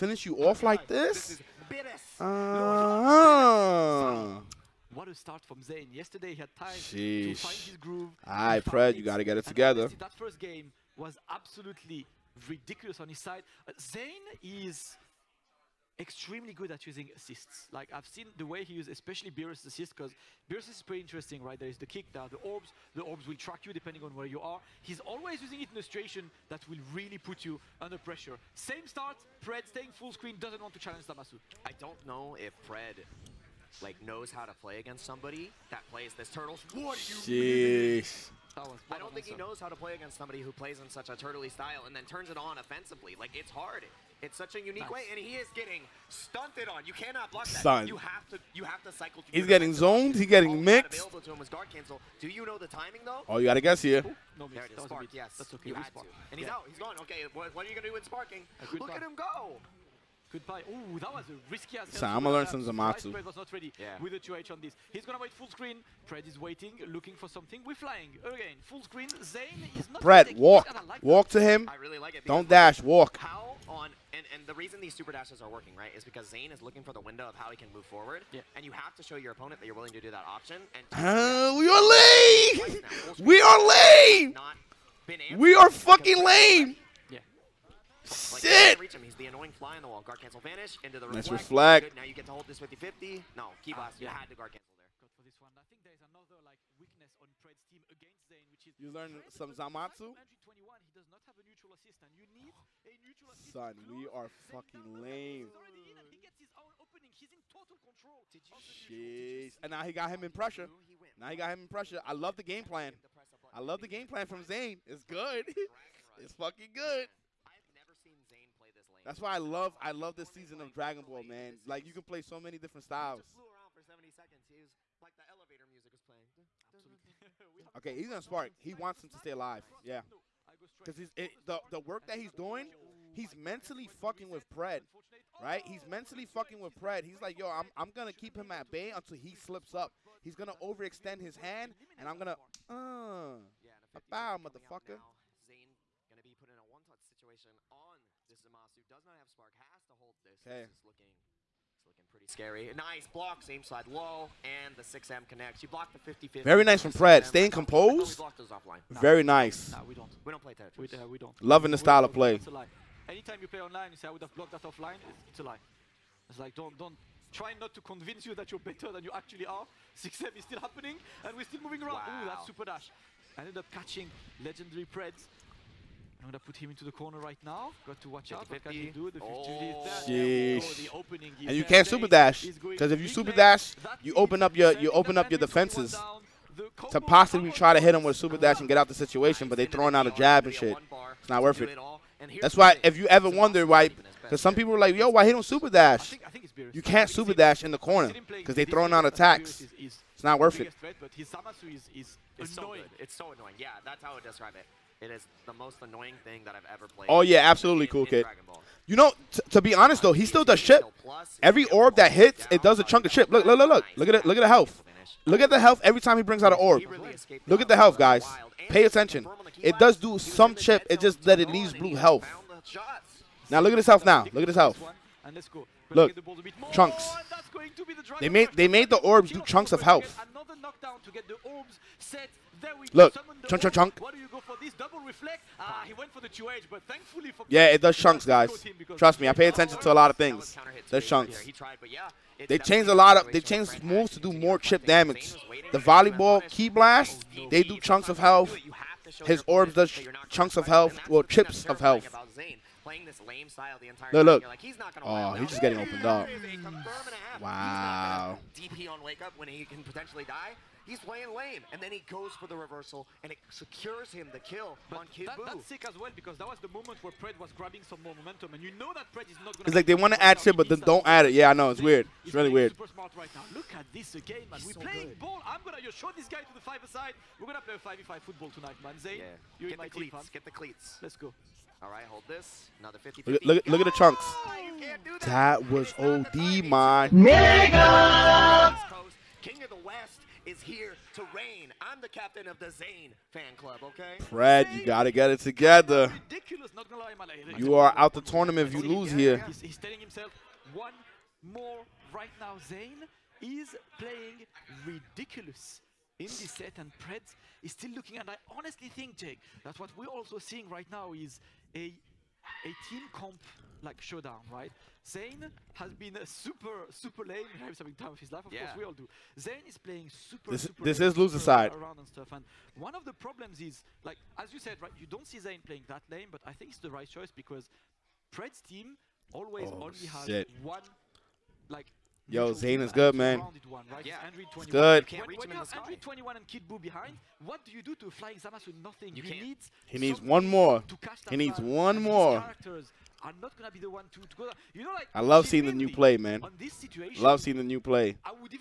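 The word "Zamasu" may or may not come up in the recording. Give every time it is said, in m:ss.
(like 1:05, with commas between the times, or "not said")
0:31, 1:02, 1:39, 2:28.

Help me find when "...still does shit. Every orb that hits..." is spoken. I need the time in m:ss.
3:30.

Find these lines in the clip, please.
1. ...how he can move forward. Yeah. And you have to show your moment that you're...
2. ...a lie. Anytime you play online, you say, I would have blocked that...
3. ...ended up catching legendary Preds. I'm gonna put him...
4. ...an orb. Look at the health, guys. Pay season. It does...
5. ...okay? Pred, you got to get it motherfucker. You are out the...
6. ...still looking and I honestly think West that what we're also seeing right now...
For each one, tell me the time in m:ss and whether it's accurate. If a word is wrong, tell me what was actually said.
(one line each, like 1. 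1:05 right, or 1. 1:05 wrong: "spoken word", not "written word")
1. 1:17 wrong: "opponent", not "moment"
2. 2:42 right
3. 2:53 right
4. 3:36 wrong: "attention", not "season"
5. 4:53 wrong: "together", not "motherfucker"
6. 5:07 wrong: "Jake", not "West".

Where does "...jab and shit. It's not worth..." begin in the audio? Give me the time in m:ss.
3:10.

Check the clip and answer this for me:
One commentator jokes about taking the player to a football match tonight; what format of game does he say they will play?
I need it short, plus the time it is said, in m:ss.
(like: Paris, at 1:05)
5v5, at 4:38.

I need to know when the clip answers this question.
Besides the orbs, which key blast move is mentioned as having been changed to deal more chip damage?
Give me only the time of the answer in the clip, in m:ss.
4:05.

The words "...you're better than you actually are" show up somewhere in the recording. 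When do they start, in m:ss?
2:48.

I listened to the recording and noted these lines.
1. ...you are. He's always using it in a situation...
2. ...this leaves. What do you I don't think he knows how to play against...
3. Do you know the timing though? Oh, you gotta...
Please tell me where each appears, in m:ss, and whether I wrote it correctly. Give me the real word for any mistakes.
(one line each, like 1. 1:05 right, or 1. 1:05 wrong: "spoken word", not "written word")
1. 0:24 right
2. 0:36 wrong: "turtles", not "leaves"
3. 0:52 right.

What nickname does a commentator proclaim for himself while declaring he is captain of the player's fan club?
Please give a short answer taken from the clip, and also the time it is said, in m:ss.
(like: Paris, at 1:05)
King of the West, at 4:49.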